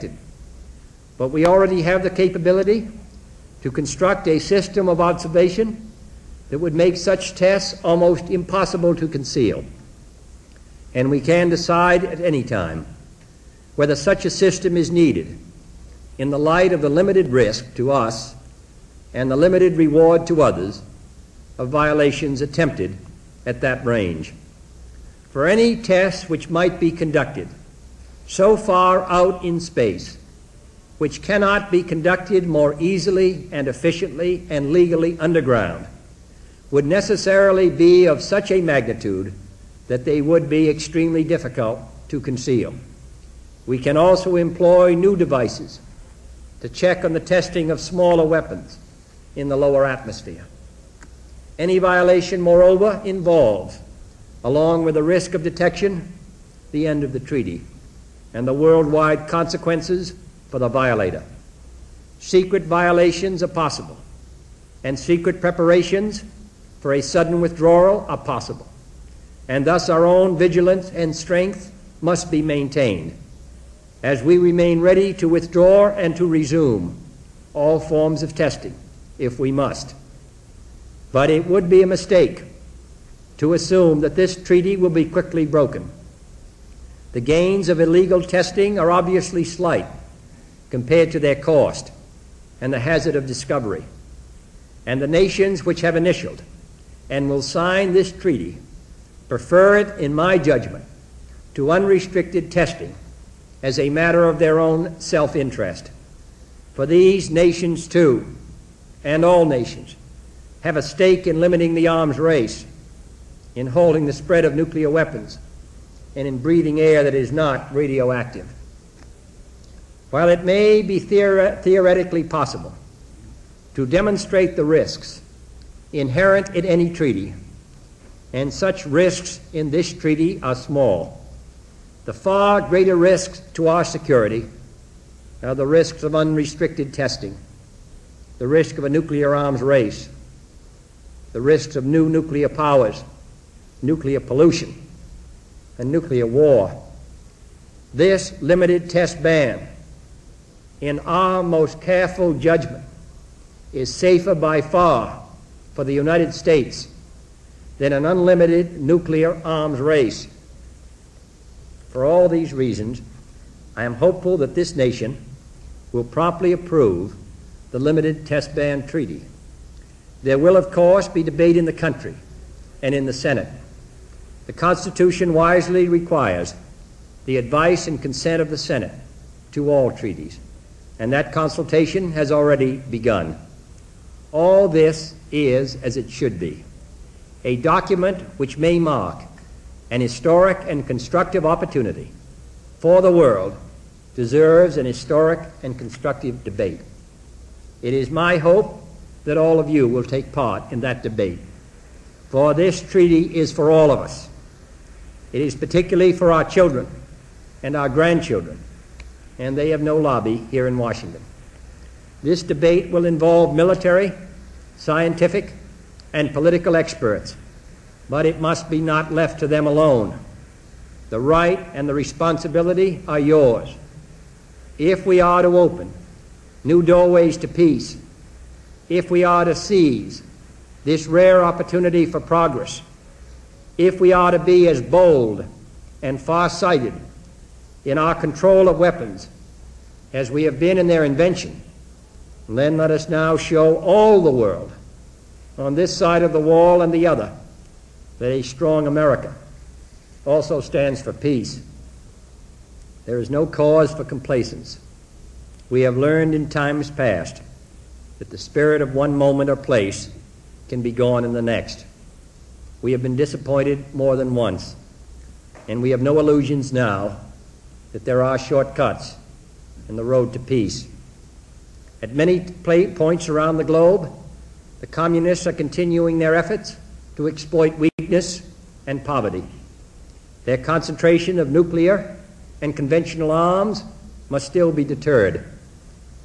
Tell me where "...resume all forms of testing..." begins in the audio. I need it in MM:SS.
01:16.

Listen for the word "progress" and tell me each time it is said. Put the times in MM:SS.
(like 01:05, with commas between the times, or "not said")
03:52.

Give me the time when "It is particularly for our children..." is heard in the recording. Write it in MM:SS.
03:25.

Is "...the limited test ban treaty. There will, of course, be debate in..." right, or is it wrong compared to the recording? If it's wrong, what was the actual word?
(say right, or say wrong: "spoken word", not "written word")
right.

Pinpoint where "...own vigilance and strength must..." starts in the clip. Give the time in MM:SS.
01:10.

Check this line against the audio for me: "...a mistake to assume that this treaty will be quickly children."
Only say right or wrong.
wrong.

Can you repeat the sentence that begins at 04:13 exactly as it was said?
There is no cause for complacence.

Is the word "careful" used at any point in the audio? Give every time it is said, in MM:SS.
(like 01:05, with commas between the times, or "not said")
02:31.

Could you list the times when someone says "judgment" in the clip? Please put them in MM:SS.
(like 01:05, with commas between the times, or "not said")
01:40, 02:32.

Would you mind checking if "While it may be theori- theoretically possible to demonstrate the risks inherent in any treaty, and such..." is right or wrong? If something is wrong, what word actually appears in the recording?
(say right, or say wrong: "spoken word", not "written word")
right.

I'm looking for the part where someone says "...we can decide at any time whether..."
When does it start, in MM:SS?
00:11.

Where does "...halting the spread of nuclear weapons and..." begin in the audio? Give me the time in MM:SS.
01:53.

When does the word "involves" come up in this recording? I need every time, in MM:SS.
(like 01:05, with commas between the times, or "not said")
00:53, 03:33.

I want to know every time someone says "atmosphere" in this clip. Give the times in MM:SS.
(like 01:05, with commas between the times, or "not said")
00:49.